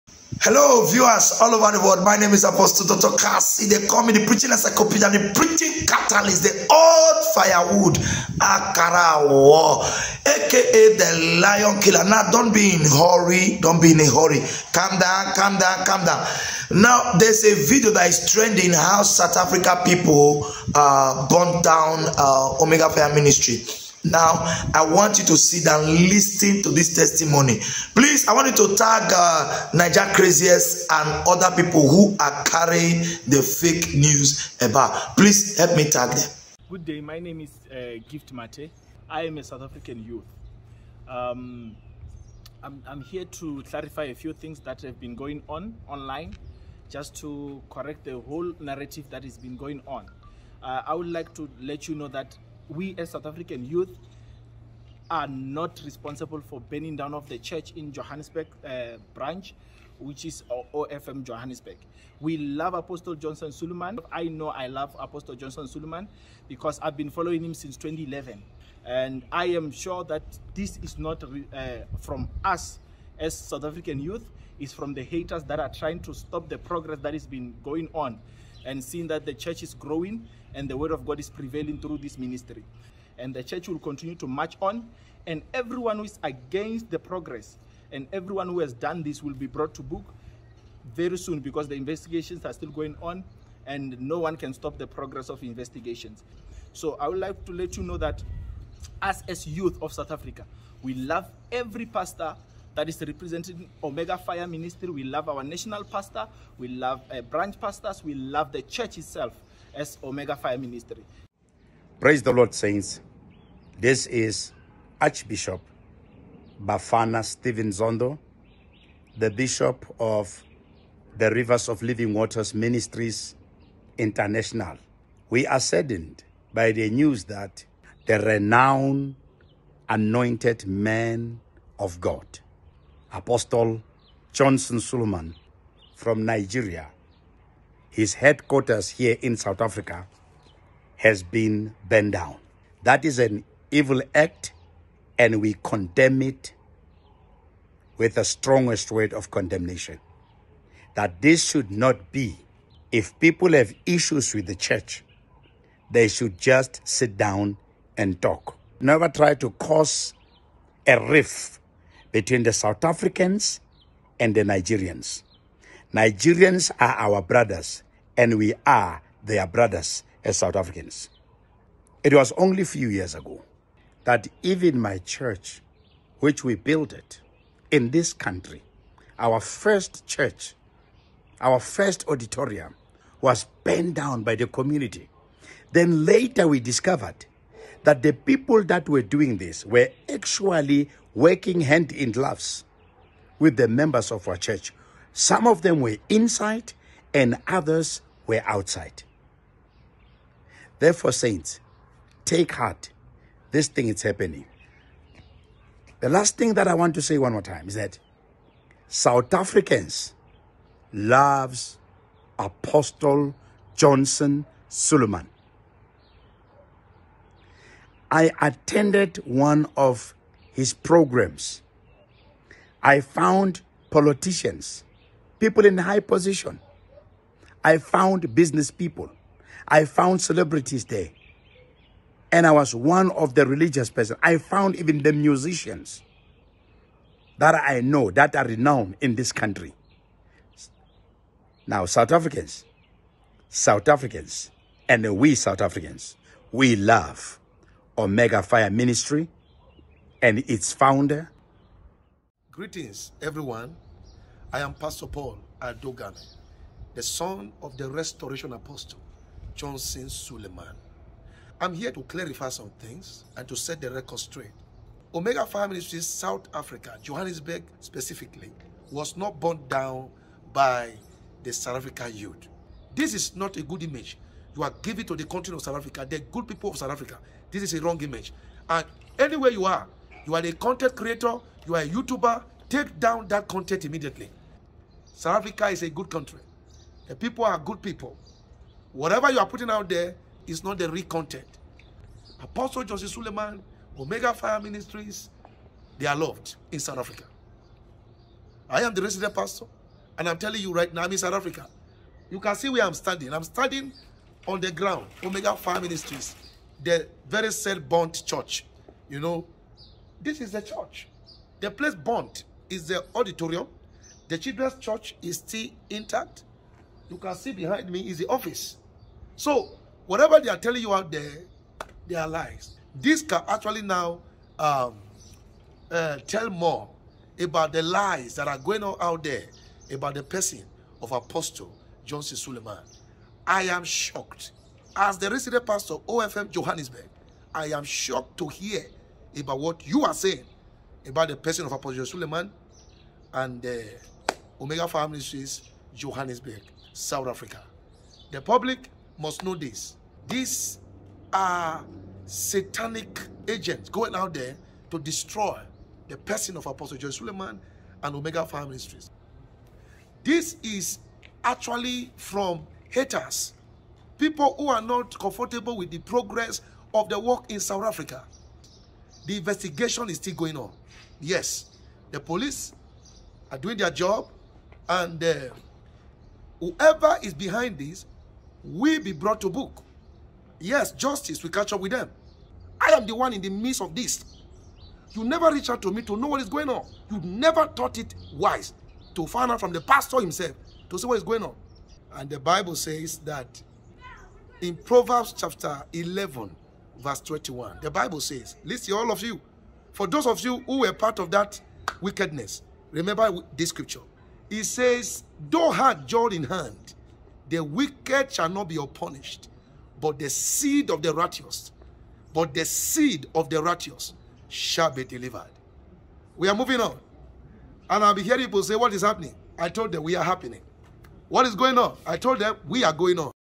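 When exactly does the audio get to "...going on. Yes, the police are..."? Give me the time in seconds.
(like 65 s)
370 s.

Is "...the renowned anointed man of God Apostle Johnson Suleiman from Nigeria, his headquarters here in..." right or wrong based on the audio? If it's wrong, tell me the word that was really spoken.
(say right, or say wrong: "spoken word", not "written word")
right.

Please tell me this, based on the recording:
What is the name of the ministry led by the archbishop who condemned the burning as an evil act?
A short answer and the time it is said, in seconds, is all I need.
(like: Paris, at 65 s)
Rivers of Living Waters Ministries International, at 121 s.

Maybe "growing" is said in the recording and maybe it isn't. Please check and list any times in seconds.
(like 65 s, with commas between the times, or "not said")
79 s.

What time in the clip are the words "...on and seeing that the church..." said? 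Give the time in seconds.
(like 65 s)
77 s.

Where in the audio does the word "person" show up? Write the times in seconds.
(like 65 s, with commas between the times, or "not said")
233 s, 330 s, 341 s, 356 s.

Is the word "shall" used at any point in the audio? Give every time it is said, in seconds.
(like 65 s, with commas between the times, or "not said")
408 s, 414 s.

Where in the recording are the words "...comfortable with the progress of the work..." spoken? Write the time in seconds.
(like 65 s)
365 s.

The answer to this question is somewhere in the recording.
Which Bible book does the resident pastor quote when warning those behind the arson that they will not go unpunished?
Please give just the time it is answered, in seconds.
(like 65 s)
394 s.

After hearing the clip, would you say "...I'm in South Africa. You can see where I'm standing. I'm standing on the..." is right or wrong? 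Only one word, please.
right.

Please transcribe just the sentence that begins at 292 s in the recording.
Apostle Joseph Suleiman, Omega Fire Ministries, they are loved in South Africa.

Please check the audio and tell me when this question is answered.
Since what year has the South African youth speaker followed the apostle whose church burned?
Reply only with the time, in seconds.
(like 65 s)
67 s.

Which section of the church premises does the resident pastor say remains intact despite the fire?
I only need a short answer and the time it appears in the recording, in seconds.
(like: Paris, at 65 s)
The children's church, at 314 s.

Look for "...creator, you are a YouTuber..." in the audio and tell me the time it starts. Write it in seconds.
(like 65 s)
280 s.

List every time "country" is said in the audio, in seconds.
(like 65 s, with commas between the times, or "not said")
178 s, 239 s, 286 s.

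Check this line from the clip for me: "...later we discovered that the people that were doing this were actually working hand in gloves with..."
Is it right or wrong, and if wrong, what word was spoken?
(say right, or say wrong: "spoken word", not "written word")
right.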